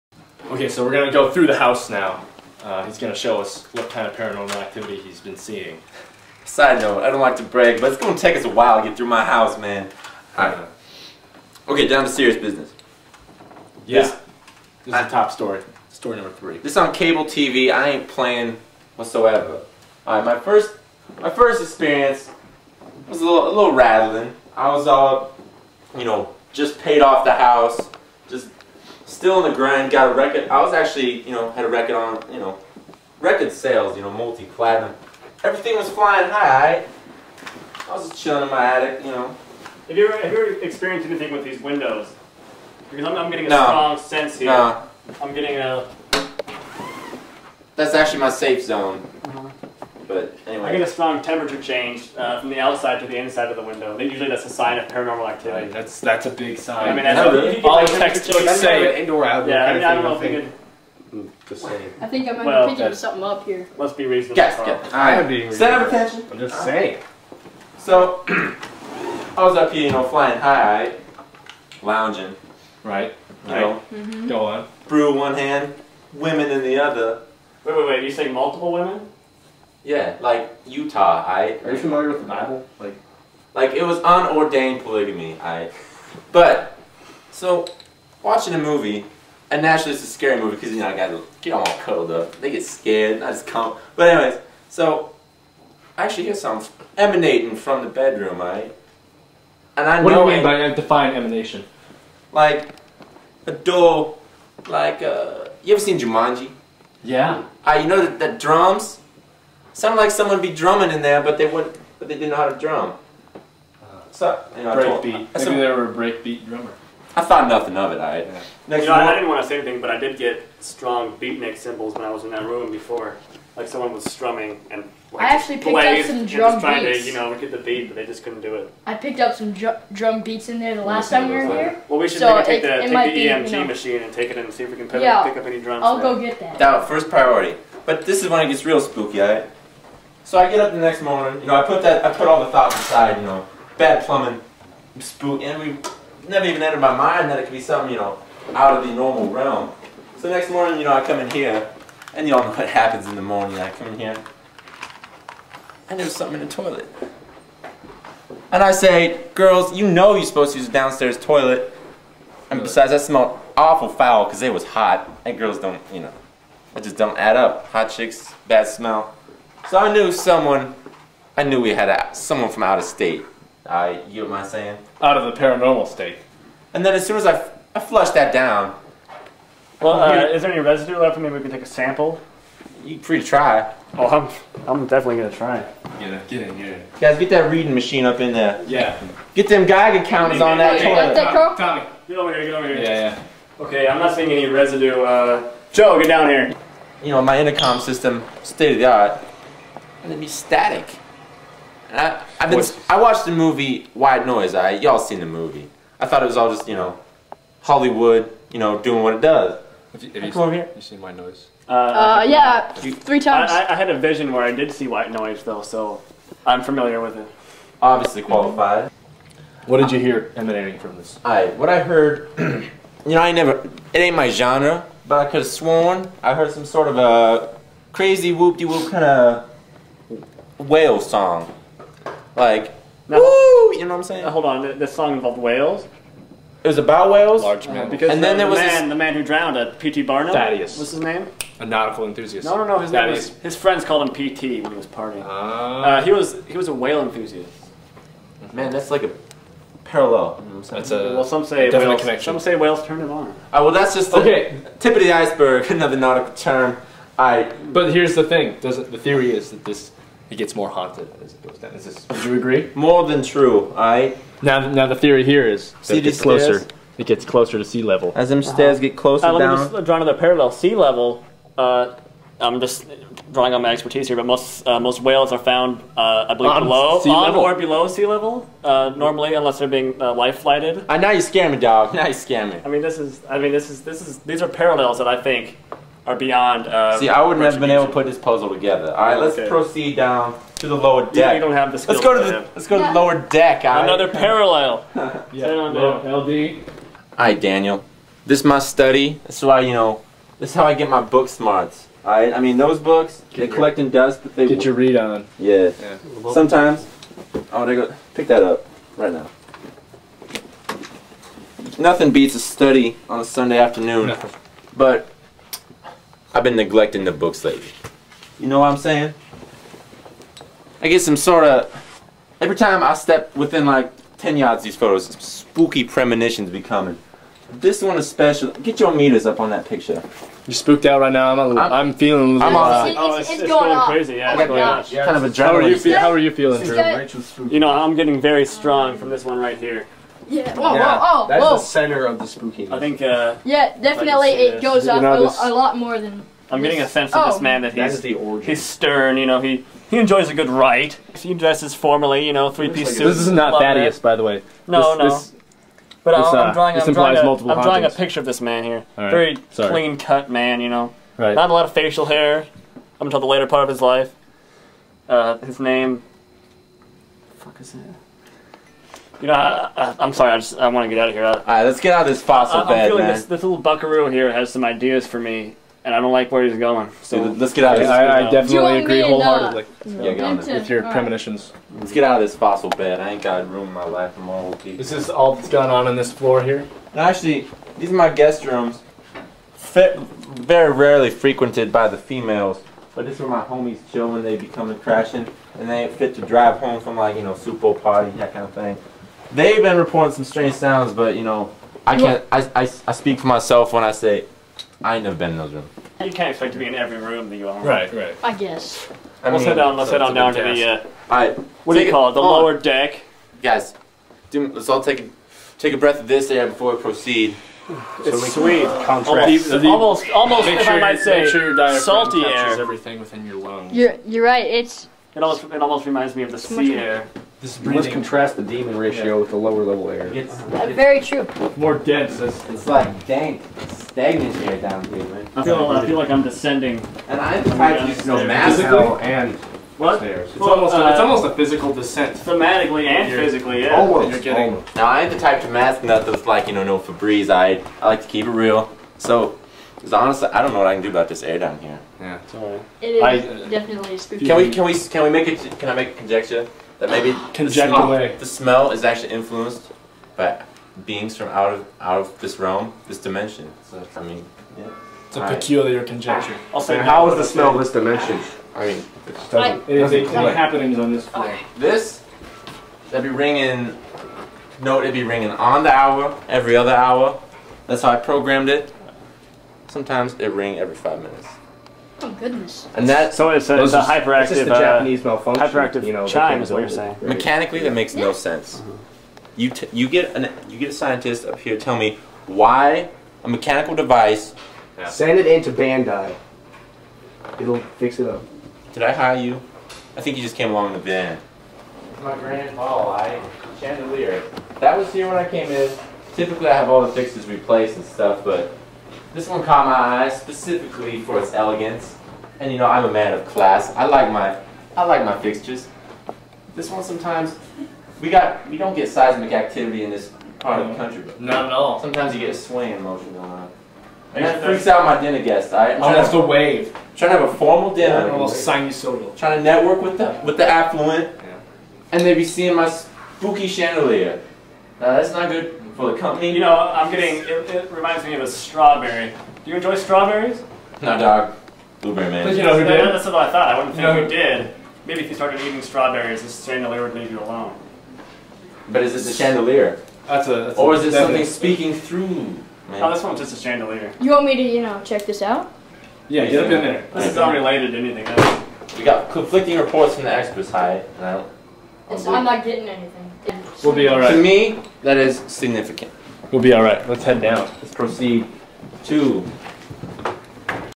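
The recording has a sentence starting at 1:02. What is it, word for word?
I think I might well, picking something up here.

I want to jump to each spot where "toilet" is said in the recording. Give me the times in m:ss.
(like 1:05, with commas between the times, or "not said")
2:36, 2:41, 3:11.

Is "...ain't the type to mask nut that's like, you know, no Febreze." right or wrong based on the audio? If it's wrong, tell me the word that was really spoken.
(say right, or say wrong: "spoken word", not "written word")
right.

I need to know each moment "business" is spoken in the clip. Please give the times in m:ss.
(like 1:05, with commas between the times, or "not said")
0:12.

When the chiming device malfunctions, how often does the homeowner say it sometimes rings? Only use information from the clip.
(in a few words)
every five minutes.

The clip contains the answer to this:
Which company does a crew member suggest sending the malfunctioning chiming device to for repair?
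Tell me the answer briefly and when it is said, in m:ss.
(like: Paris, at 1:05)
Bandai, at 8:15.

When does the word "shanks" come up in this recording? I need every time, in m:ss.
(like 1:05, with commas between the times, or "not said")
not said.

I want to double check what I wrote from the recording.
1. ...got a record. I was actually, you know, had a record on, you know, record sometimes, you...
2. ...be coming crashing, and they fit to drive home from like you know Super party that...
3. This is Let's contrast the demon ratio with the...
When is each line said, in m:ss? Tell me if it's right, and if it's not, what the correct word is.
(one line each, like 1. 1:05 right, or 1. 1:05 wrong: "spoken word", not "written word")
1. 0:29 wrong: "sales", not "sometimes"
2. 6:34 right
3. 7:07 right.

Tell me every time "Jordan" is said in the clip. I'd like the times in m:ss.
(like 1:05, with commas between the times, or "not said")
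not said.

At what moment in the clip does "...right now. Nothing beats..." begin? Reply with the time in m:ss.
5:08.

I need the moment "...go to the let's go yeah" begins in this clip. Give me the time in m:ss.
4:52.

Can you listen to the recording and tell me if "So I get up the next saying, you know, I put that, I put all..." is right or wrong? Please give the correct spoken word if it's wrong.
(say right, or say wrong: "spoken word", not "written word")
wrong: "morning", not "saying".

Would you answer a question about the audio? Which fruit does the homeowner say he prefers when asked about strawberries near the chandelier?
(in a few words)
Blueberry.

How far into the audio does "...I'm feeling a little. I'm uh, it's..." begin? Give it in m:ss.
5:31.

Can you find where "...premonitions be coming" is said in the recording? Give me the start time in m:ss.
5:25.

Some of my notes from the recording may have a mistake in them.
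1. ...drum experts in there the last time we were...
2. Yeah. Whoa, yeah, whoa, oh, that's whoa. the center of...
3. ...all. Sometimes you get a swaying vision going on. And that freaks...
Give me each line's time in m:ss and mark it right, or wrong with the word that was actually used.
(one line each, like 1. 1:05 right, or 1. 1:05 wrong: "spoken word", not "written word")
1. 2:09 wrong: "beats", not "experts"
2. 5:40 right
3. 8:41 wrong: "motion", not "vision".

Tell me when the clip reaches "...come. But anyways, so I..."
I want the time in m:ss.
1:33.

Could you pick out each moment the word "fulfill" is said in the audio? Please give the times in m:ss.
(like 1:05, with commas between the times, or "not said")
not said.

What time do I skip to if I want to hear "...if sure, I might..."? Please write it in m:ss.
7:00.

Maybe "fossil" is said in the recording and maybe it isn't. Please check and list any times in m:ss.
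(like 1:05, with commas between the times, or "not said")
6:12, 6:22.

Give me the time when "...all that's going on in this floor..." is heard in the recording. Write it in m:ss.
6:25.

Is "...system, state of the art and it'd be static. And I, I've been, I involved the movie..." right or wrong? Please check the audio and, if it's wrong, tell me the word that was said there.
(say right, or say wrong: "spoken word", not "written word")
wrong: "watched", not "involved".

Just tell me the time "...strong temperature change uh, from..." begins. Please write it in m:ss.
0:50.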